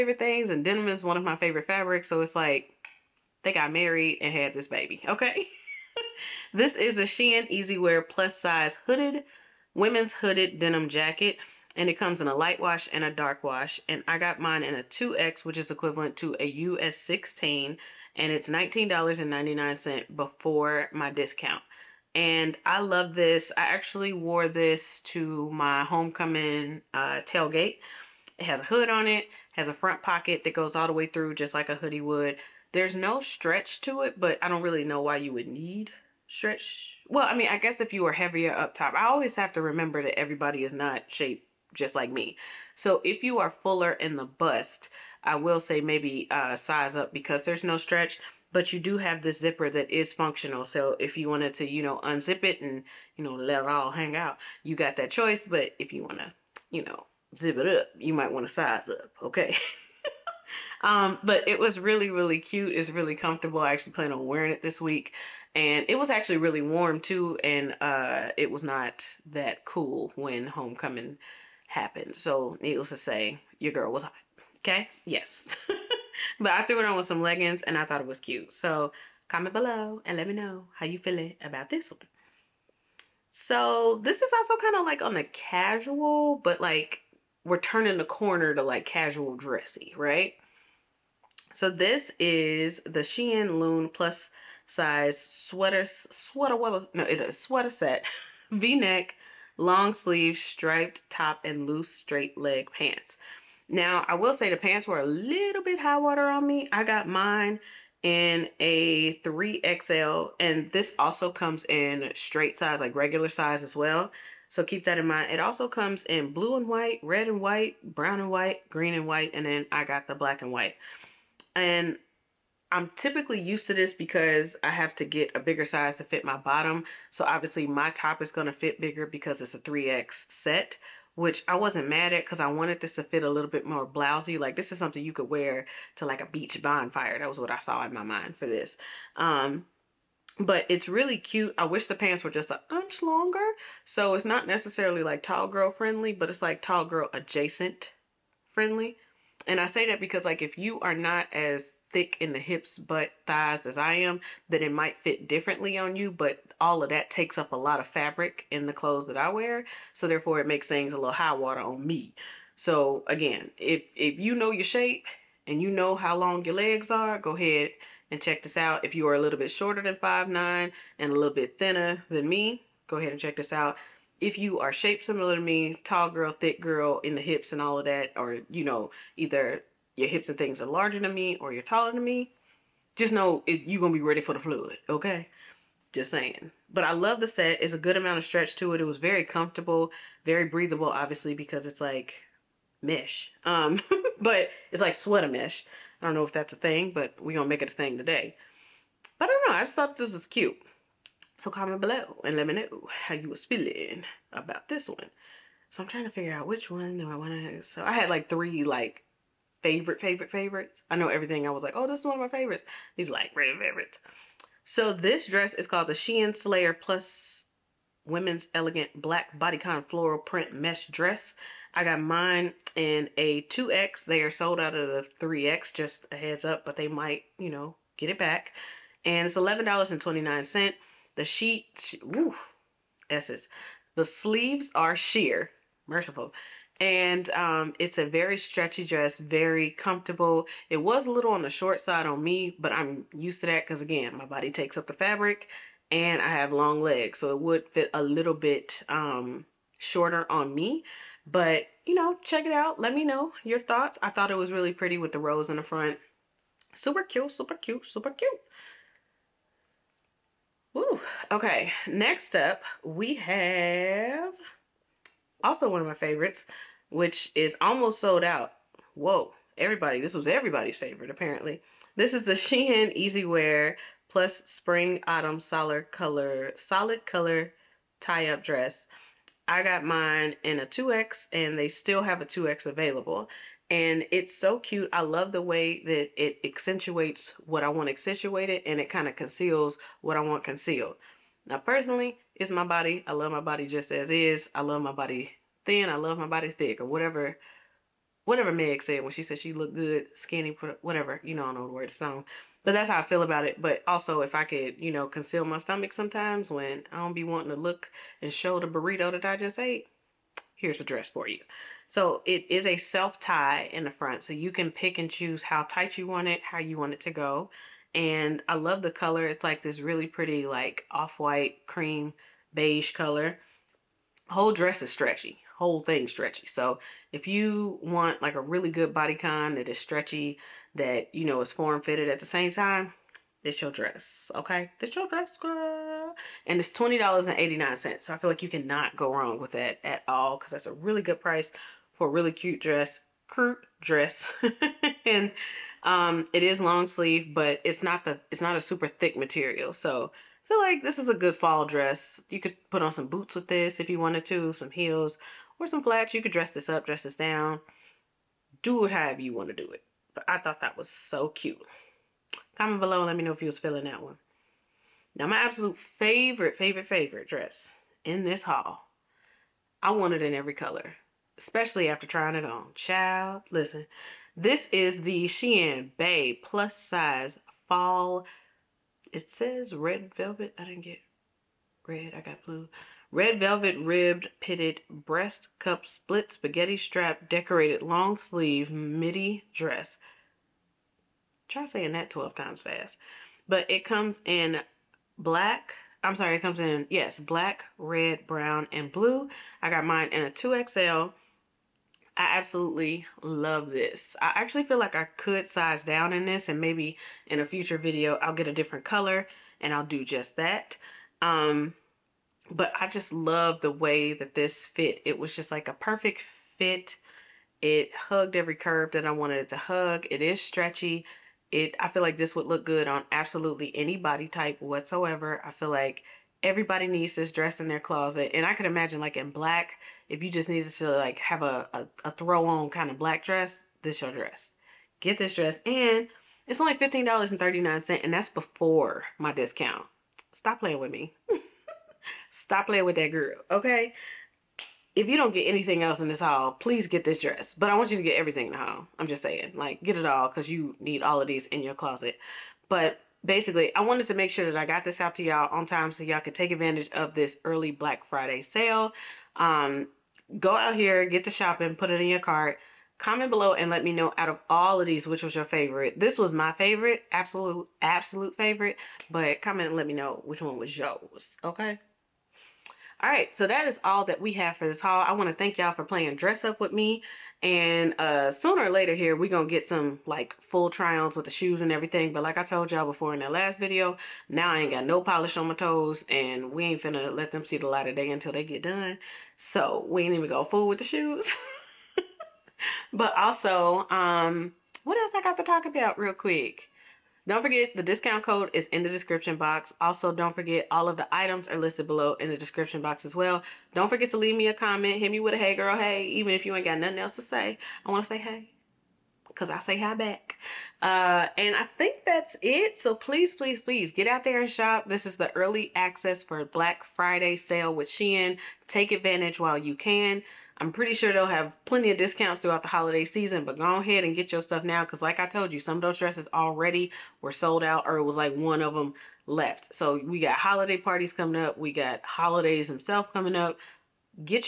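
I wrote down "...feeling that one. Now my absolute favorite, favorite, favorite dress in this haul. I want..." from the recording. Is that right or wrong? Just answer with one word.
right.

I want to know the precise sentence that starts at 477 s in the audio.
And uh, sooner or later here, we're going to get some like full try-ons with the shoes and everything.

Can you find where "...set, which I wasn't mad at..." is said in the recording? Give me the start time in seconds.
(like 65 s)
130 s.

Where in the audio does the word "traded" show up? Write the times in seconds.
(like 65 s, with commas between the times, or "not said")
not said.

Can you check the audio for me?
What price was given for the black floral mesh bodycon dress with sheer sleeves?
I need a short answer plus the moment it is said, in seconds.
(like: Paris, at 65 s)
$11.29, at 229 s.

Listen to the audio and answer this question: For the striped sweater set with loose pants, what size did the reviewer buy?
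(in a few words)
3XL.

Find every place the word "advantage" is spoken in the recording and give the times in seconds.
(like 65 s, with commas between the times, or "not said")
456 s, 518 s.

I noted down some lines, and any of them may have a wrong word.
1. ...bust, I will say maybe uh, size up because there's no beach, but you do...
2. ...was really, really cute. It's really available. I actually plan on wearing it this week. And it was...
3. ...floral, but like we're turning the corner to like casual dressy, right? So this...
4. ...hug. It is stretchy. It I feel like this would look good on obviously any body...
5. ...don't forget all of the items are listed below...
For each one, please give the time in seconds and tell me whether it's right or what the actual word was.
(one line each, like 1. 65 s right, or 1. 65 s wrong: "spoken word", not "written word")
1. 44 s wrong: "stretch", not "beach"
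2. 61 s wrong: "comfortable", not "available"
3. 85 s wrong: "casual", not "floral"
4. 419 s wrong: "absolutely", not "obviously"
5. 500 s right.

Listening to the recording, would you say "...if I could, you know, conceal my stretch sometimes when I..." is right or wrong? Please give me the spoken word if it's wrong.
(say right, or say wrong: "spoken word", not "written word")
wrong: "stomach", not "stretch".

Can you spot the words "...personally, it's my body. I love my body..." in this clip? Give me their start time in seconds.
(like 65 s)
291 s.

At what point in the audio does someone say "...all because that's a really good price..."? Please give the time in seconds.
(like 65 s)
340 s.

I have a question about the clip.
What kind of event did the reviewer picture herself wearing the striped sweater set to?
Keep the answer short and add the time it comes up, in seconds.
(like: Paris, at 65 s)
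beach bonfire, at 136 s.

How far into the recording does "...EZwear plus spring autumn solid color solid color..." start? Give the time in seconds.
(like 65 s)
272 s.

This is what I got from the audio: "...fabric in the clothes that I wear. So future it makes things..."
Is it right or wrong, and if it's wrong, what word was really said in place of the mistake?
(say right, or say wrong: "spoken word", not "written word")
wrong: "therefore", not "future".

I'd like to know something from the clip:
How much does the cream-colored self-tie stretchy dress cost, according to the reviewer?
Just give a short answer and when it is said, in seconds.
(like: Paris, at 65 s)
$20.89, at 336 s.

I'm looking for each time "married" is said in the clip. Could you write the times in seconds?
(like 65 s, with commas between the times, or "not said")
3 s.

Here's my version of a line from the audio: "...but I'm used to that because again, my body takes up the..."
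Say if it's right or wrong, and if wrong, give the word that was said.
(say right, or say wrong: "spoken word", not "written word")
right.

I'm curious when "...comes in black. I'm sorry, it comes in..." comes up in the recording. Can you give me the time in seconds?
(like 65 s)
393 s.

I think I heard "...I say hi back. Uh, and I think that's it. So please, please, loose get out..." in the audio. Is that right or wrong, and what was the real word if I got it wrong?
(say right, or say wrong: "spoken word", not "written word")
wrong: "please", not "loose".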